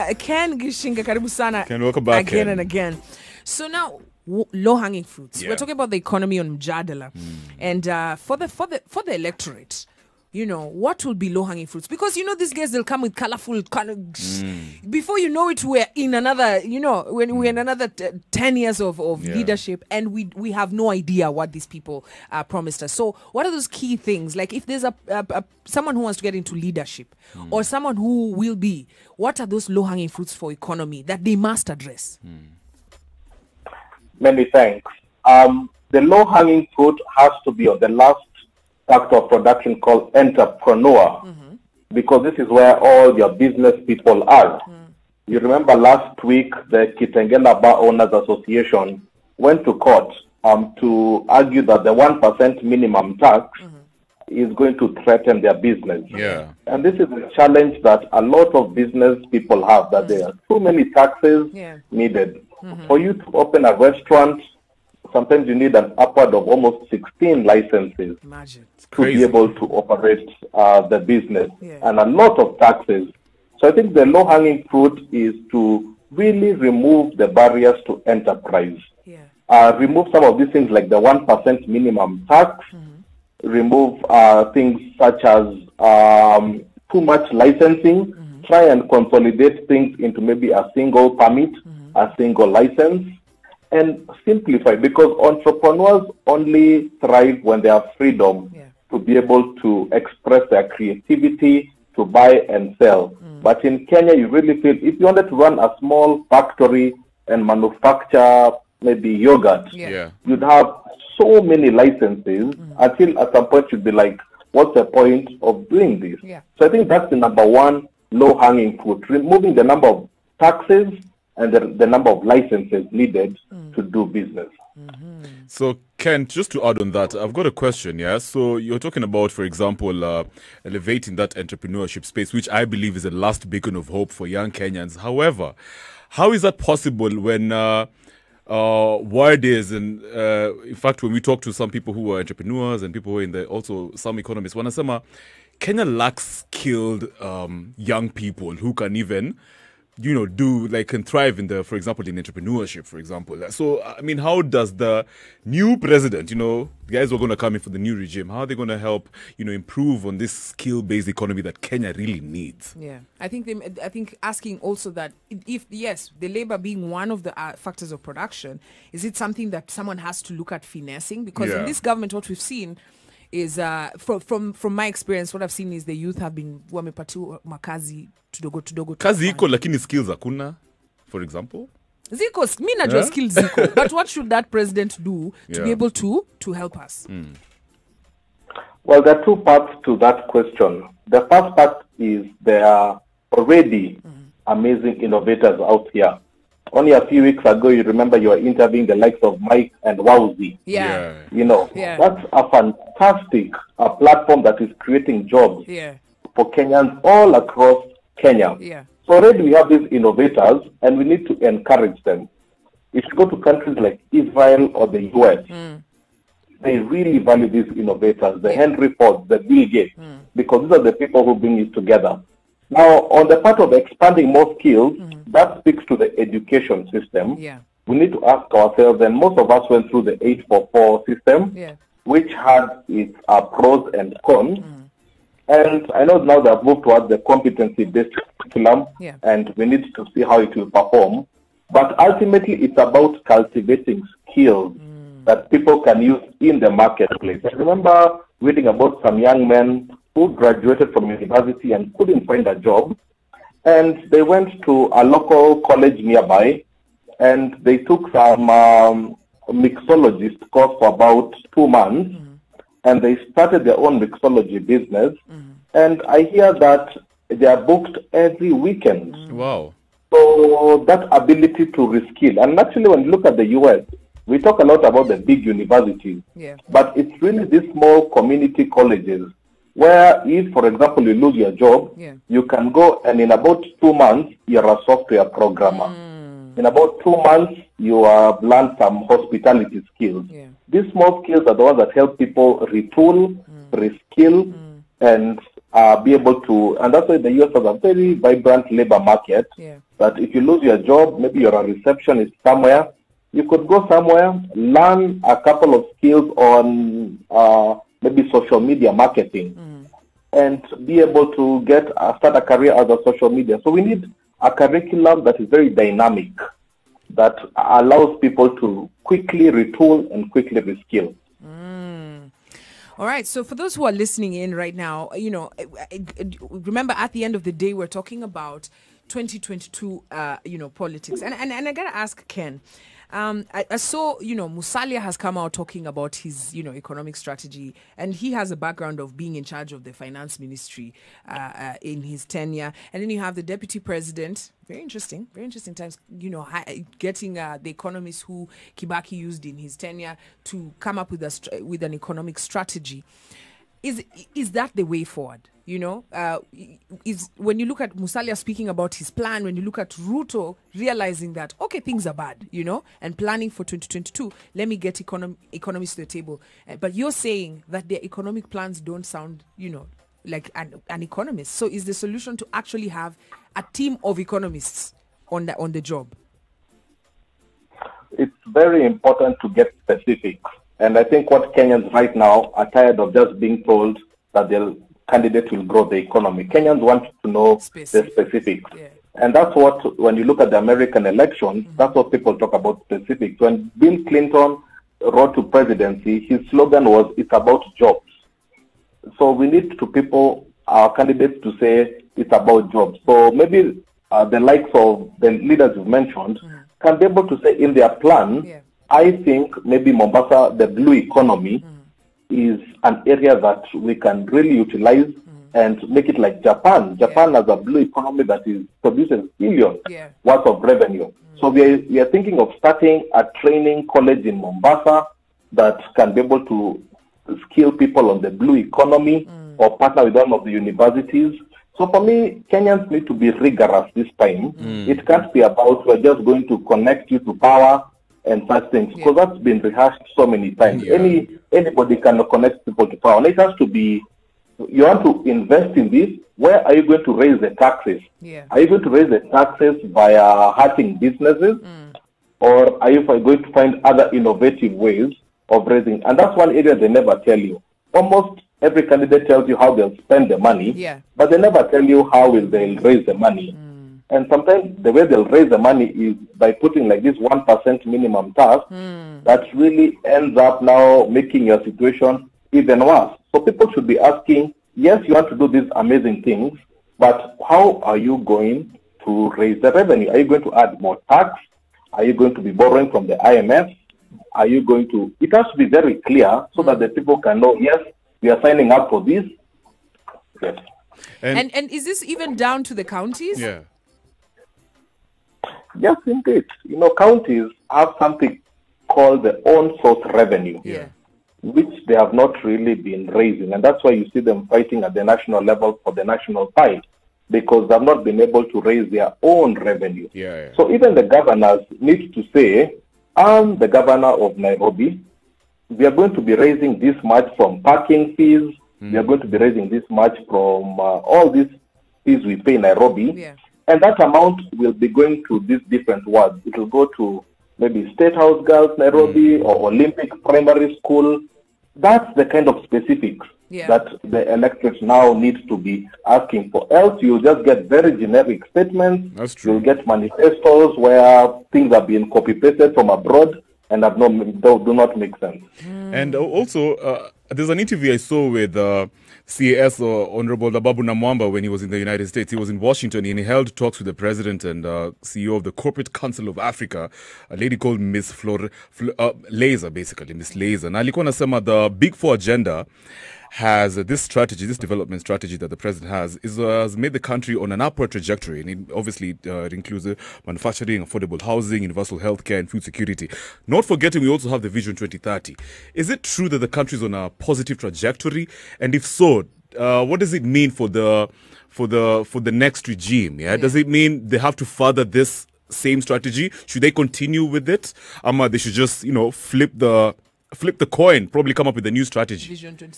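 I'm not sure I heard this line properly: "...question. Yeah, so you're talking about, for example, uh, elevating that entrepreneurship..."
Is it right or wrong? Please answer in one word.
right.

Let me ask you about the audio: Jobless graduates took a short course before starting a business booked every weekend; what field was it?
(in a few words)
mixology.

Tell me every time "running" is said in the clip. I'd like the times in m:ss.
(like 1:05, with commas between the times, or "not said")
not said.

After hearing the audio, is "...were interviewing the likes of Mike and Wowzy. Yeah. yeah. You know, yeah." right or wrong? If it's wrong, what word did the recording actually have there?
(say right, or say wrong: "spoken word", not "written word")
right.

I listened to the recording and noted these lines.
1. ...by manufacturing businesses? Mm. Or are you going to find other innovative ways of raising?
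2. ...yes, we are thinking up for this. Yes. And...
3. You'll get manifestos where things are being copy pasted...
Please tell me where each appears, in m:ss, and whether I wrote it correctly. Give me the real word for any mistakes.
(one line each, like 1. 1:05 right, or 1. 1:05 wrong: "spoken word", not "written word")
1. 7:29 wrong: "hurting", not "manufacturing"
2. 8:07 wrong: "signing", not "thinking"
3. 8:59 right.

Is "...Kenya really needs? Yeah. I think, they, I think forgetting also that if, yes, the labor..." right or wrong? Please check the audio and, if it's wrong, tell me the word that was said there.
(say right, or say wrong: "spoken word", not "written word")
wrong: "asking", not "forgetting".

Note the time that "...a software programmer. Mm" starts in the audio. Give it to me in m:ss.
4:44.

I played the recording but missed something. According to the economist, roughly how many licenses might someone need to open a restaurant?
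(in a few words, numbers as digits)
16.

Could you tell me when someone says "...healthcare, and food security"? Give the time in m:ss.
9:31.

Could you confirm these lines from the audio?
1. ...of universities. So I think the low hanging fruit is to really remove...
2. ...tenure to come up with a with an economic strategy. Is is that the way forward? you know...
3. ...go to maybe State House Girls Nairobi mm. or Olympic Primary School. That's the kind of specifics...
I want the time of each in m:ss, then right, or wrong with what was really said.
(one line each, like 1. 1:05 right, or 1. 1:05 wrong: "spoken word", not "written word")
1. 1:12 wrong: "taxes", not "universities"
2. 5:49 right
3. 8:46 right.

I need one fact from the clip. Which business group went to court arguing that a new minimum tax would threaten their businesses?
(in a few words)
Kitengela Bar Owners Association.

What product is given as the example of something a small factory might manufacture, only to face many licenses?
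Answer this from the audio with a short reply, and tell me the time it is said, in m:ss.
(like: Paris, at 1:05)
yogurt, at 1:49.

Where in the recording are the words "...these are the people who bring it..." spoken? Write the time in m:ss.
3:40.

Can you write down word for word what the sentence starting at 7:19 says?
that's been rehearsed so many times.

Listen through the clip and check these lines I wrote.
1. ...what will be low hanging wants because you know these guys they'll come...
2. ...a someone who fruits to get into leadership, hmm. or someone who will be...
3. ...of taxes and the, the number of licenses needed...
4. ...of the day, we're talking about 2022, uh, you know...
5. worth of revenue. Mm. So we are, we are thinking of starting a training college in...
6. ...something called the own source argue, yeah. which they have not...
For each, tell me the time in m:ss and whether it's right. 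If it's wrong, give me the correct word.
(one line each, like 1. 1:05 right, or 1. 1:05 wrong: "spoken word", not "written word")
1. 0:10 wrong: "fruits", not "wants"
2. 0:25 wrong: "wants", not "fruits"
3. 1:59 right
4. 5:27 right
5. 7:00 right
6. 8:17 wrong: "revenue", not "argue".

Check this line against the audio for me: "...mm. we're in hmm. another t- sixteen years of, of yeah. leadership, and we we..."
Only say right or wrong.
wrong.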